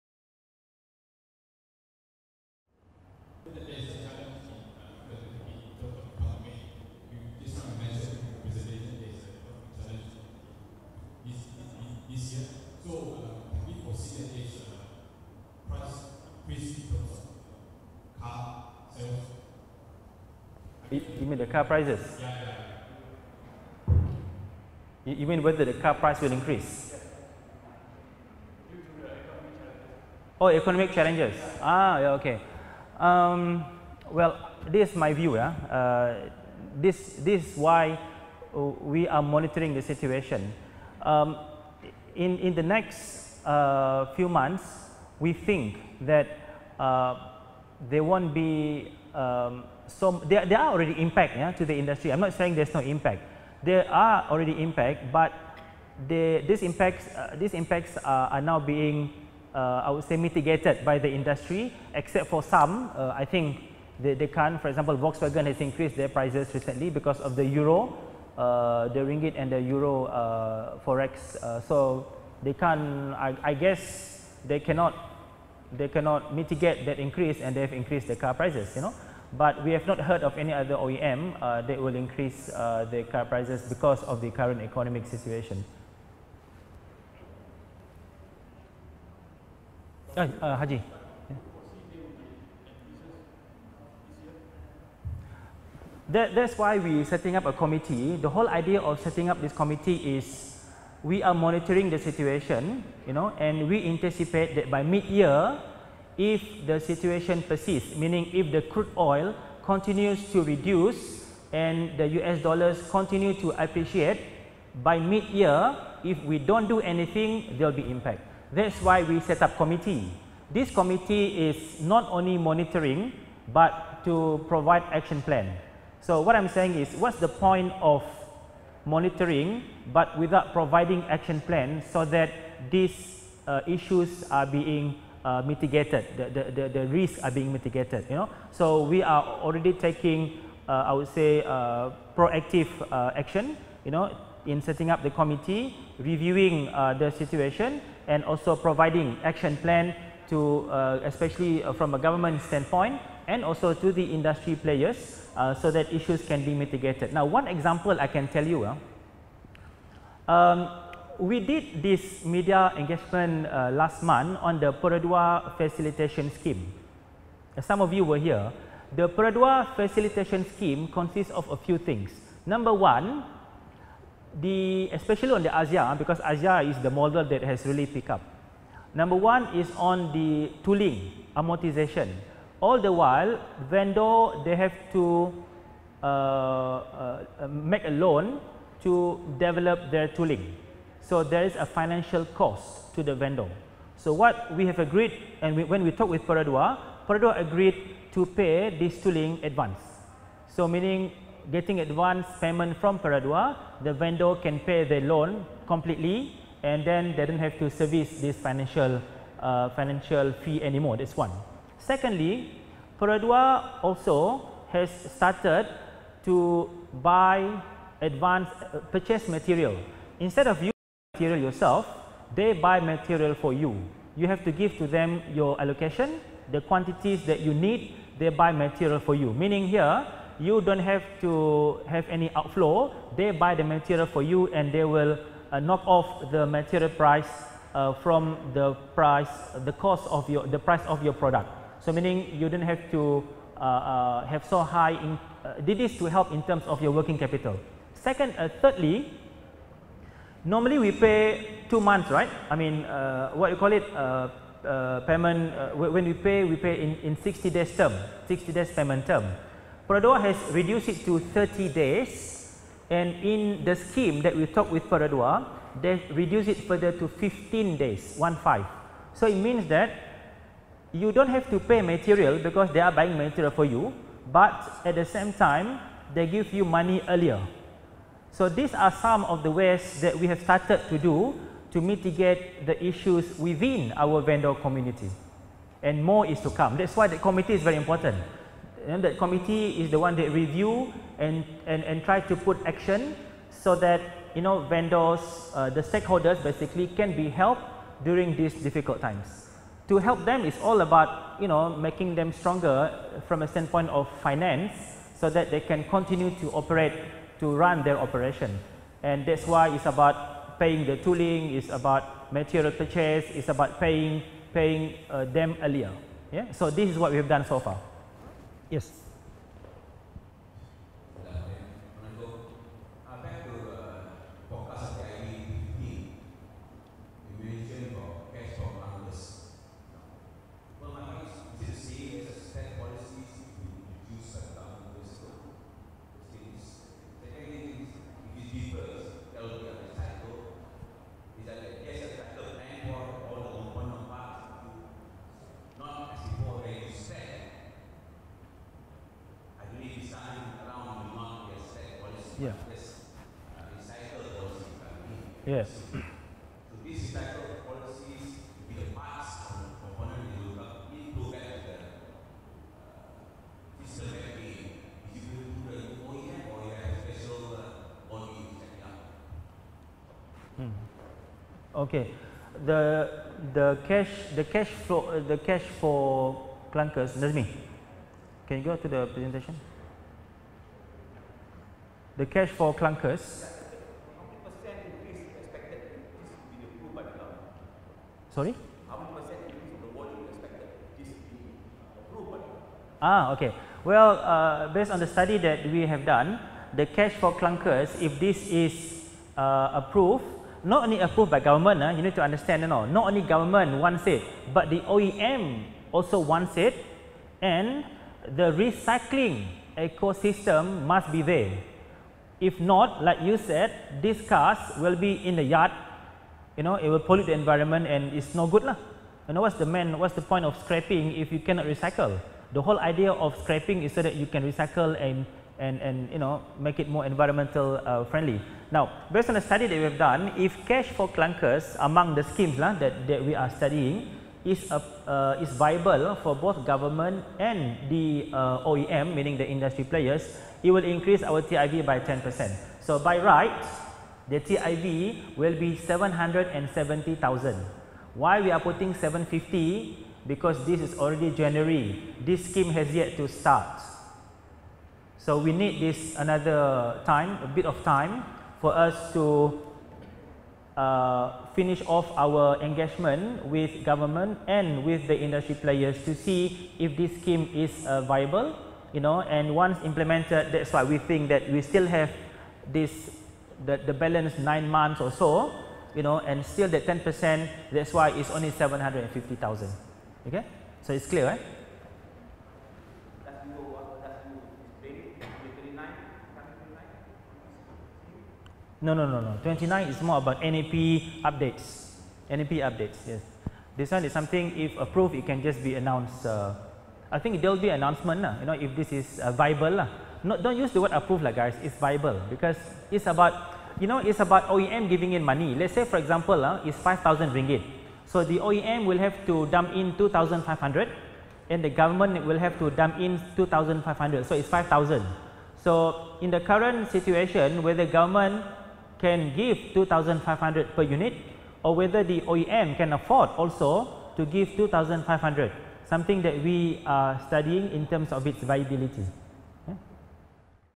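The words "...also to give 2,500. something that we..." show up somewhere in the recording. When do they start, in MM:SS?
08:43.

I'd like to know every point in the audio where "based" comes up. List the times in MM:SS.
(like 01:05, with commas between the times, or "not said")
06:34, 07:09.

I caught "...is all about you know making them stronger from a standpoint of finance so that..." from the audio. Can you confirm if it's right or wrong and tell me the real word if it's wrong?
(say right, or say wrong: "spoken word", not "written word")
right.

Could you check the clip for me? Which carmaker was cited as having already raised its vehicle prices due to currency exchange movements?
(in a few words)
Volkswagen.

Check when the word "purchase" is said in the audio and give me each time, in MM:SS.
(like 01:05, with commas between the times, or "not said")
03:38, 05:12.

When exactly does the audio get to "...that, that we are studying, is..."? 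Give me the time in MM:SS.
07:12.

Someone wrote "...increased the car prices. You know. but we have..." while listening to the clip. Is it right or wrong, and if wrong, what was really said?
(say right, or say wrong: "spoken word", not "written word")
right.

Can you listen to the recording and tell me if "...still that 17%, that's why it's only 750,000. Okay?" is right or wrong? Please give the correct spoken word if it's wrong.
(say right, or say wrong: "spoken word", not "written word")
wrong: "10", not "17".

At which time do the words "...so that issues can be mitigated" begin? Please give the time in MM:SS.
02:35.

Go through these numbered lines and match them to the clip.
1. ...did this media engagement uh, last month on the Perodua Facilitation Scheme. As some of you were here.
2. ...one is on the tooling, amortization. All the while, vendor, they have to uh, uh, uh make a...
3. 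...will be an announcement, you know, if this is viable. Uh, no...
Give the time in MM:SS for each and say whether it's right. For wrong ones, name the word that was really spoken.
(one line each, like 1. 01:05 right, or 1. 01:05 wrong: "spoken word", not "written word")
1. 02:41 right
2. 02:59 right
3. 08:17 right.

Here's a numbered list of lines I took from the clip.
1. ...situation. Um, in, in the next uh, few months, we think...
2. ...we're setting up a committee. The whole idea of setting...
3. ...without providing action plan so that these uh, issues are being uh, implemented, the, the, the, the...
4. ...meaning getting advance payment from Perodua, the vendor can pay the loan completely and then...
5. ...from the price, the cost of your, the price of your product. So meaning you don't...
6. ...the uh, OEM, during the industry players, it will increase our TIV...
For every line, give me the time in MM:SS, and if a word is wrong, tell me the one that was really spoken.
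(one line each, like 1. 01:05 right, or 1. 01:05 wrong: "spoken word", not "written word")
1. 00:39 right
2. 01:36 right
3. 02:10 wrong: "mitigated", not "implemented"
4. 03:20 right
5. 03:57 right
6. 07:17 wrong: "meaning", not "during".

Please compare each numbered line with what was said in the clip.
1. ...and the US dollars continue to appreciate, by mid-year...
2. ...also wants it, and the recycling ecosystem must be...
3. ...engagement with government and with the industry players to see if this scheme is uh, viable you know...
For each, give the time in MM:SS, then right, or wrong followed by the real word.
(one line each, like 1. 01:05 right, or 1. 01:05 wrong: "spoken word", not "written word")
1. 01:51 right
2. 06:45 right
3. 07:42 right.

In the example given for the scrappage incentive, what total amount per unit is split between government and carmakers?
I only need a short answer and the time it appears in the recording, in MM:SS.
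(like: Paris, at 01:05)
5,000 ringgit, at 08:26.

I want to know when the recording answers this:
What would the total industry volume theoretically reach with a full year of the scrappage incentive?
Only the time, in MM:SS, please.
07:25.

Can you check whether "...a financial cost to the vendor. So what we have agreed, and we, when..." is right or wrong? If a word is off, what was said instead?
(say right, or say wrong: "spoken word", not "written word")
right.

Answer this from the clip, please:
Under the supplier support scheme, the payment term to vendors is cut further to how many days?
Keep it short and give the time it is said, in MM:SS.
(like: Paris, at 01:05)
15 days, at 04:27.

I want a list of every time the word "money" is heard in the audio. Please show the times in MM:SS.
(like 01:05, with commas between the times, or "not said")
04:36, 08:25.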